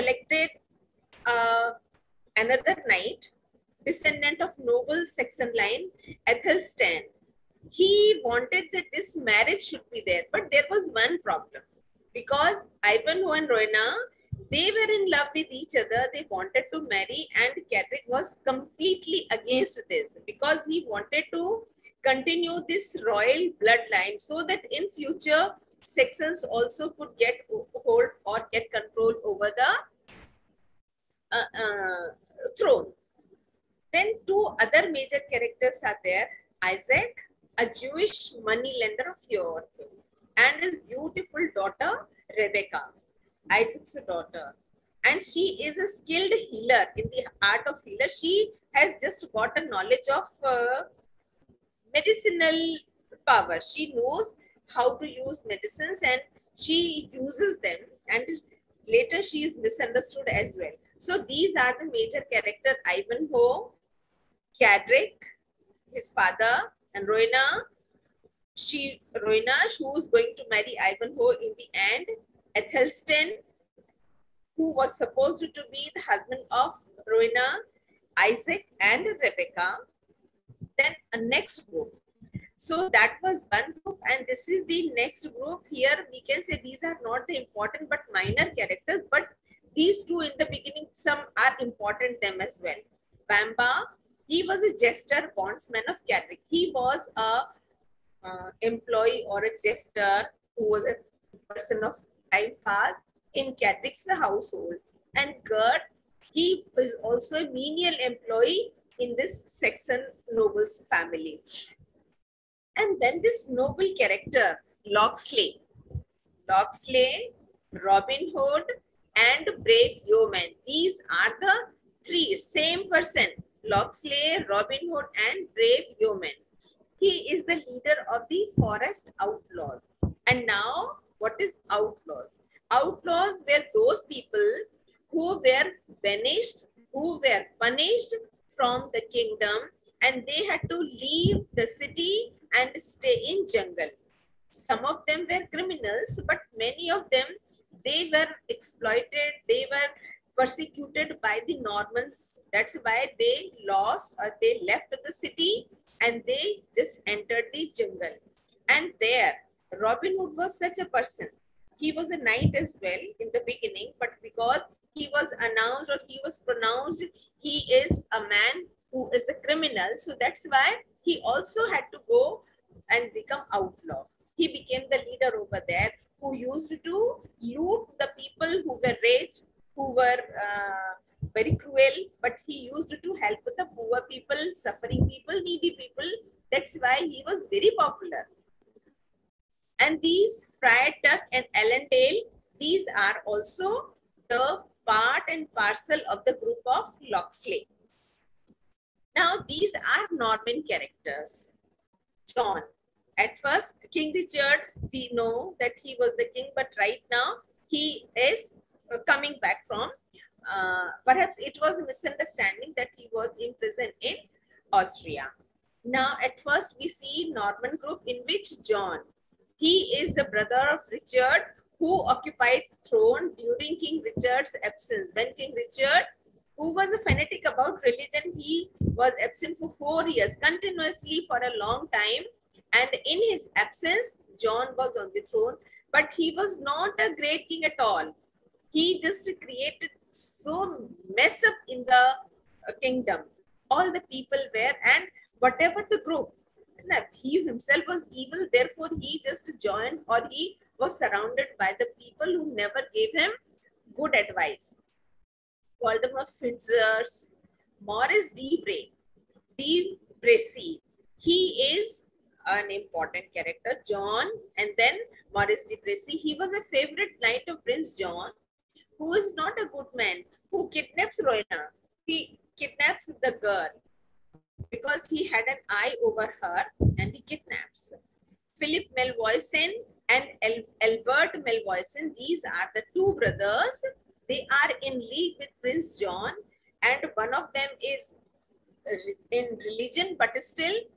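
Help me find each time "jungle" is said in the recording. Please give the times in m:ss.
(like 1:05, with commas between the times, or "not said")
2:23, 2:37.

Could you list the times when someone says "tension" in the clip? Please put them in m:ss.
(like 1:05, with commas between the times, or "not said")
not said.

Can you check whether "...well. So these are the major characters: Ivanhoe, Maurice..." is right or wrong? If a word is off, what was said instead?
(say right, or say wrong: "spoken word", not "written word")
wrong: "Cadric", not "Maurice".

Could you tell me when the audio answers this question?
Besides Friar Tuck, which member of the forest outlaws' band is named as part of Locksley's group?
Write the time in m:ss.
3:11.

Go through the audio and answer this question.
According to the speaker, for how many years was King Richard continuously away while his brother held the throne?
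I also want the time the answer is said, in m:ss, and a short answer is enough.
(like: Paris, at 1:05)
4, at 3:49.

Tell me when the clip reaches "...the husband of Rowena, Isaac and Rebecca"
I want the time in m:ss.
1:15.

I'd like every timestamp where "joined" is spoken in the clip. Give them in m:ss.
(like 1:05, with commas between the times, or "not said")
4:09.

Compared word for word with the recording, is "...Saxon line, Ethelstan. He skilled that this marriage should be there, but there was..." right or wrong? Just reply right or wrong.
wrong.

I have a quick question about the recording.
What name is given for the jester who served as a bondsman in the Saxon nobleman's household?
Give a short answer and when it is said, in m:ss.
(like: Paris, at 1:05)
Bamba, at 1:33.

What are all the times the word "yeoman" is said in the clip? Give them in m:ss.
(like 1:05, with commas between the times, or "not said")
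2:00, 2:06.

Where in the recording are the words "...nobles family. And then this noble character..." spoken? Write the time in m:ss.
1:50.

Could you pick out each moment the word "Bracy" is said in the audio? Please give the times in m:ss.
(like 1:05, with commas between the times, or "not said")
4:20, 4:25.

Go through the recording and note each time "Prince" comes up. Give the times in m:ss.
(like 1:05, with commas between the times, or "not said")
4:27, 4:45.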